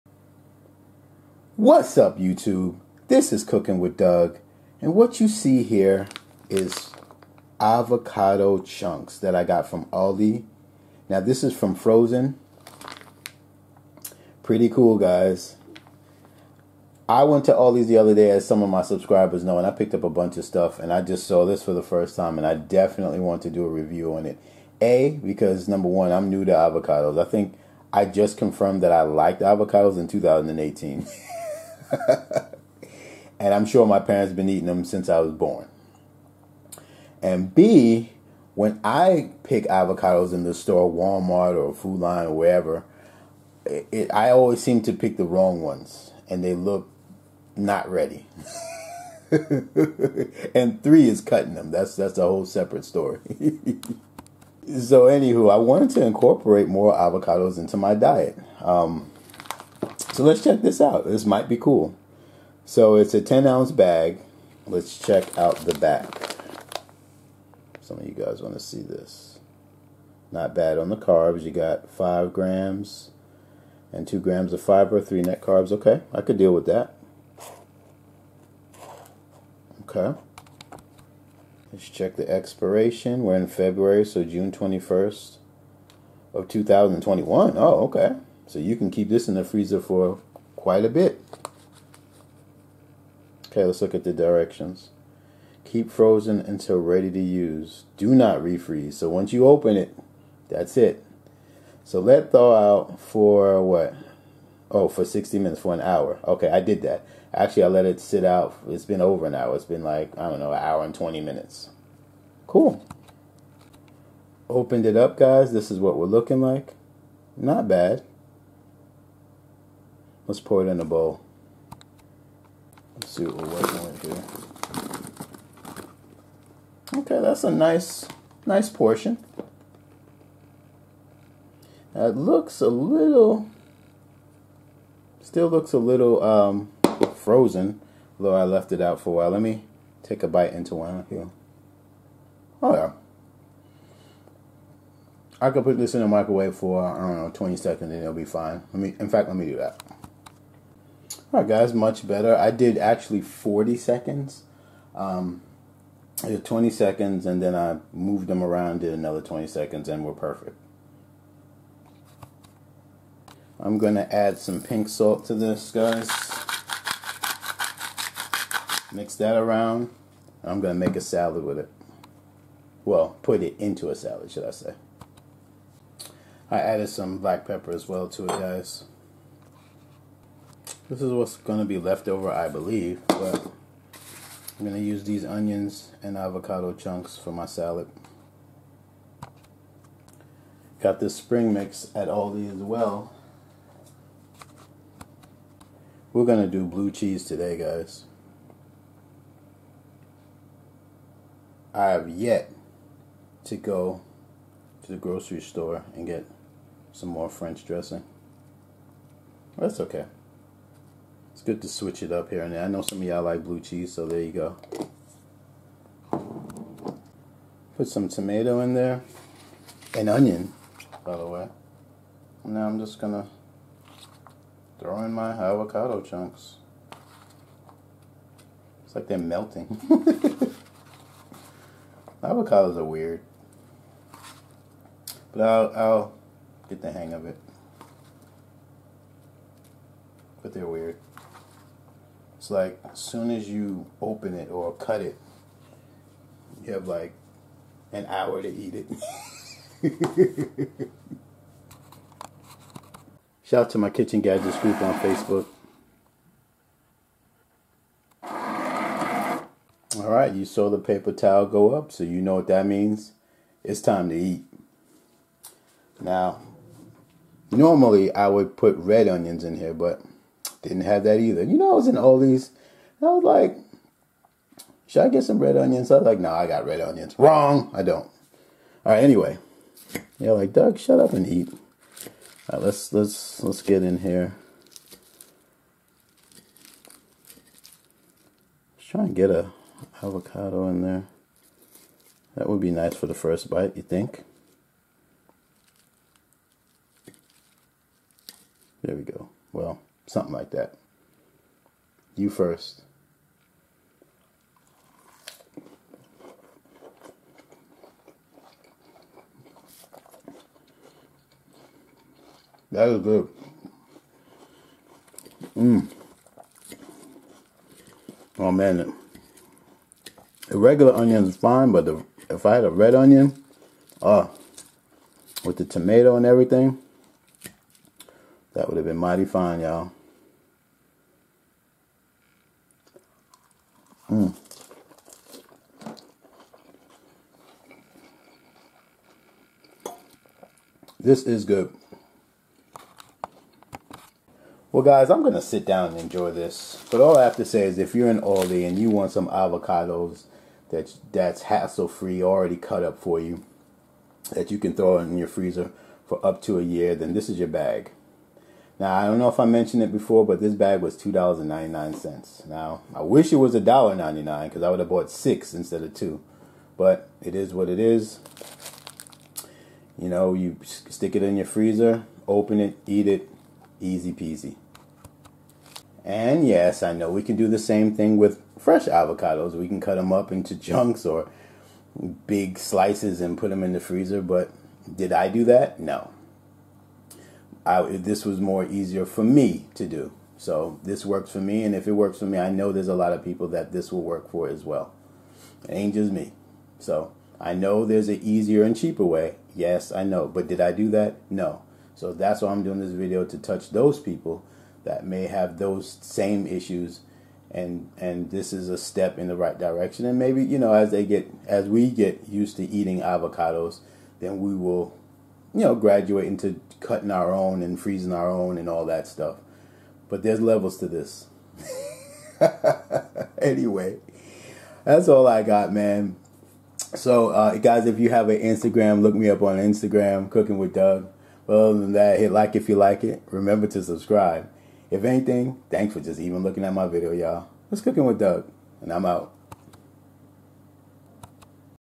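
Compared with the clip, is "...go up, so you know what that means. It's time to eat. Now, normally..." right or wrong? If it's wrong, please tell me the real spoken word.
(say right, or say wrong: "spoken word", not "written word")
right.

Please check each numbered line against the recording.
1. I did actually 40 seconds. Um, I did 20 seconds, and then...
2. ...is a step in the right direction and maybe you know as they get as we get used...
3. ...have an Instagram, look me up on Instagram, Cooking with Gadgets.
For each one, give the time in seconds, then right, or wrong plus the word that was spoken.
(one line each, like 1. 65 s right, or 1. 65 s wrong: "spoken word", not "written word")
1. 152 s right
2. 408 s right
3. 428 s wrong: "Doug", not "Gadgets".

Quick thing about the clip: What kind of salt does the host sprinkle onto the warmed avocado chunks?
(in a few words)
pink salt.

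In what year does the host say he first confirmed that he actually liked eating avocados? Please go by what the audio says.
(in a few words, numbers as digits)
2018.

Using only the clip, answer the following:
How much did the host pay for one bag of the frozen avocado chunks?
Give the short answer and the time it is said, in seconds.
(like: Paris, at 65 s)
$2.99, at 360 s.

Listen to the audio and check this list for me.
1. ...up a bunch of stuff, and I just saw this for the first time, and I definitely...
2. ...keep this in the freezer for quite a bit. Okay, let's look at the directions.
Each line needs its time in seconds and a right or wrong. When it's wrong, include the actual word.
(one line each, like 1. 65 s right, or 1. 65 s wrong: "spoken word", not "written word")
1. 19 s right
2. 88 s right.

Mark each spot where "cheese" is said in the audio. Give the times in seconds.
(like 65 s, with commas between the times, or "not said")
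196 s, 213 s.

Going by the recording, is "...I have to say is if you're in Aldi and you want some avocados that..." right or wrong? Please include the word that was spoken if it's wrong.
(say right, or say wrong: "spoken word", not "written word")
right.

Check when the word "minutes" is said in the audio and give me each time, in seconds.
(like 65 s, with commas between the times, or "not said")
105 s, 111 s.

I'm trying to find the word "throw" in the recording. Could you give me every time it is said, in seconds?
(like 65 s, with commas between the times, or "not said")
224 s, 354 s.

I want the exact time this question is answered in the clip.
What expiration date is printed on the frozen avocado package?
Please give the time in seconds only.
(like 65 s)
84 s.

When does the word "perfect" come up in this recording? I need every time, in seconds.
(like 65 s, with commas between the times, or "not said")
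160 s.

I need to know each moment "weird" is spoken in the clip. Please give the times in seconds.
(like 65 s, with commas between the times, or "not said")
232 s, 240 s.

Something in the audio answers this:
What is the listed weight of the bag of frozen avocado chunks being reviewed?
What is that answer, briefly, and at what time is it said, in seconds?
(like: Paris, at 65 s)
10 ounces, at 63 s.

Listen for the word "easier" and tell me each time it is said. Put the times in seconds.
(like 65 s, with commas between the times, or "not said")
388 s, 398 s.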